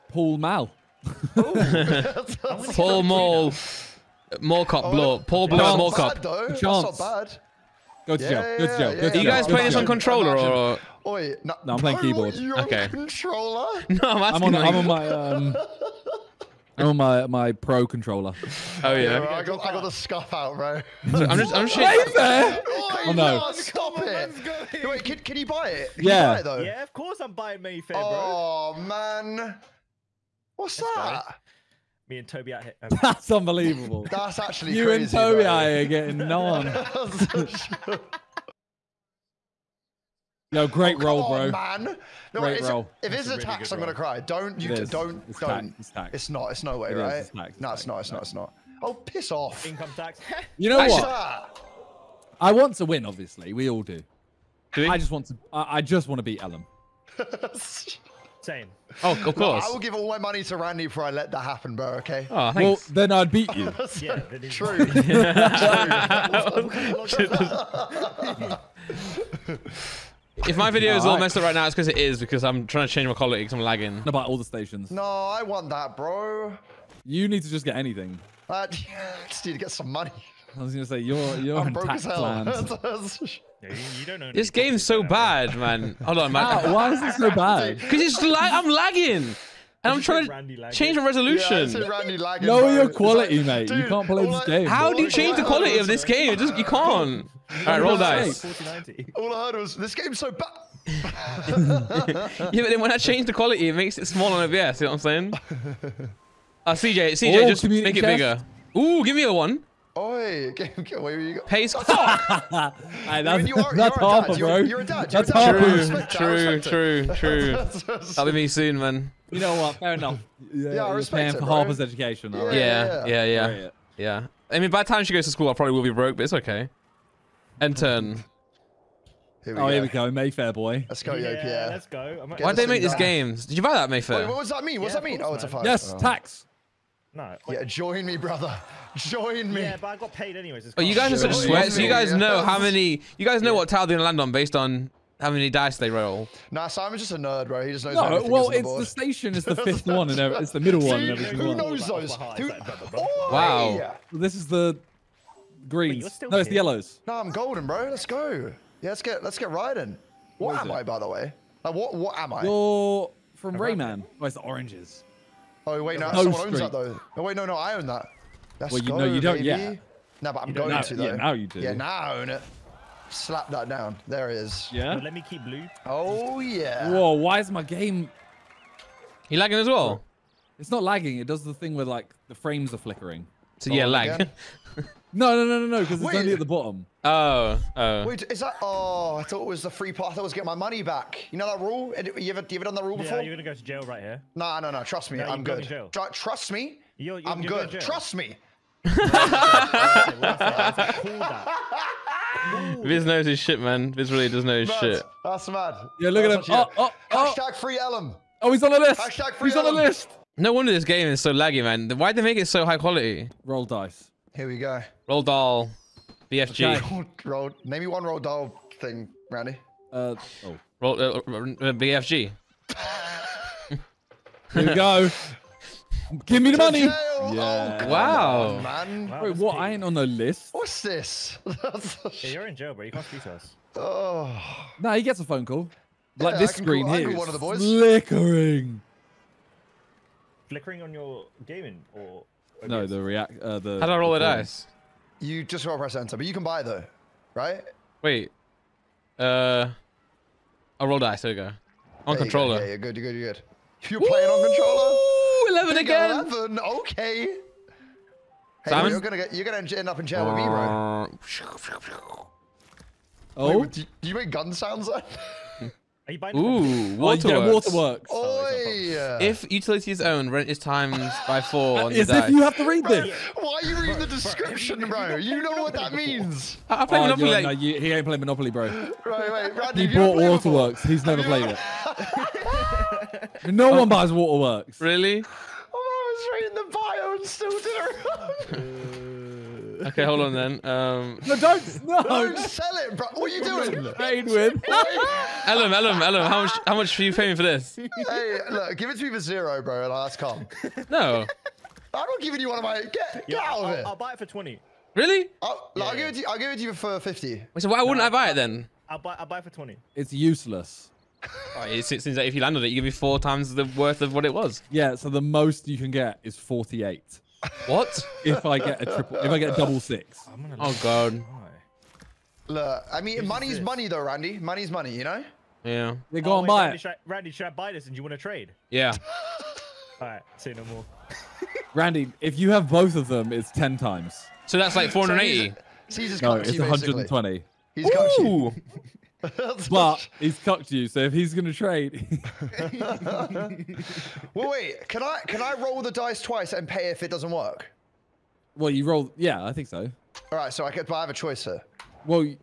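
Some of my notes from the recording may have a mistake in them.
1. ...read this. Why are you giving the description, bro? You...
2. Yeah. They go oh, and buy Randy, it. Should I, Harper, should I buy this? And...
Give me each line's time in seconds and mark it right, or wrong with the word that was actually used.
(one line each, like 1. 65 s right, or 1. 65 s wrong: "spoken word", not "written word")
1. 272 s wrong: "reading", not "giving"
2. 325 s wrong: "Randy", not "Harper".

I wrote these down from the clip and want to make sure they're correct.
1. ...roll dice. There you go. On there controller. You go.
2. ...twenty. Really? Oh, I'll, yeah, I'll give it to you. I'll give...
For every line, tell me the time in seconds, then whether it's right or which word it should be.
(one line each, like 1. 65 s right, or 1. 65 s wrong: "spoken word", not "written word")
1. 250 s right
2. 304 s right.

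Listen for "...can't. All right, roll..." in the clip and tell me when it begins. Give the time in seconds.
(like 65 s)
96 s.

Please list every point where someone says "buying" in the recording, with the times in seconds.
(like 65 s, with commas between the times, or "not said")
27 s, 266 s.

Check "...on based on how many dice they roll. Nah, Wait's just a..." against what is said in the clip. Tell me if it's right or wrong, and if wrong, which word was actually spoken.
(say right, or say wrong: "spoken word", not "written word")
wrong: "Simon", not "Wait".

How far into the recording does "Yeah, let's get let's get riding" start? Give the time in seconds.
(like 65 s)
158 s.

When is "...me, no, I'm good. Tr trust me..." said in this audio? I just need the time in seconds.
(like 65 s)
195 s.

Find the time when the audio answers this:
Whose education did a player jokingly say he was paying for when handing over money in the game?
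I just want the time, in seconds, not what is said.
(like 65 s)
121 s.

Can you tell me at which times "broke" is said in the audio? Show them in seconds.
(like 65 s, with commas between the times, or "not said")
81 s, 125 s.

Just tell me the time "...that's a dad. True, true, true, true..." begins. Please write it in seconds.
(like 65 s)
115 s.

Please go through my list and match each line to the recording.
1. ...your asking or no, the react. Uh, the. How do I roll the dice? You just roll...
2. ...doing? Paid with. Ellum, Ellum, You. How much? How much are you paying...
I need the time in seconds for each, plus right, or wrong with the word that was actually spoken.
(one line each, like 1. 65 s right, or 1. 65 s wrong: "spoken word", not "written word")
1. 240 s wrong: "gaming", not "asking"
2. 293 s wrong: "Ellum", not "You".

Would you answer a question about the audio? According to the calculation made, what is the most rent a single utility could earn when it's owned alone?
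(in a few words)
48.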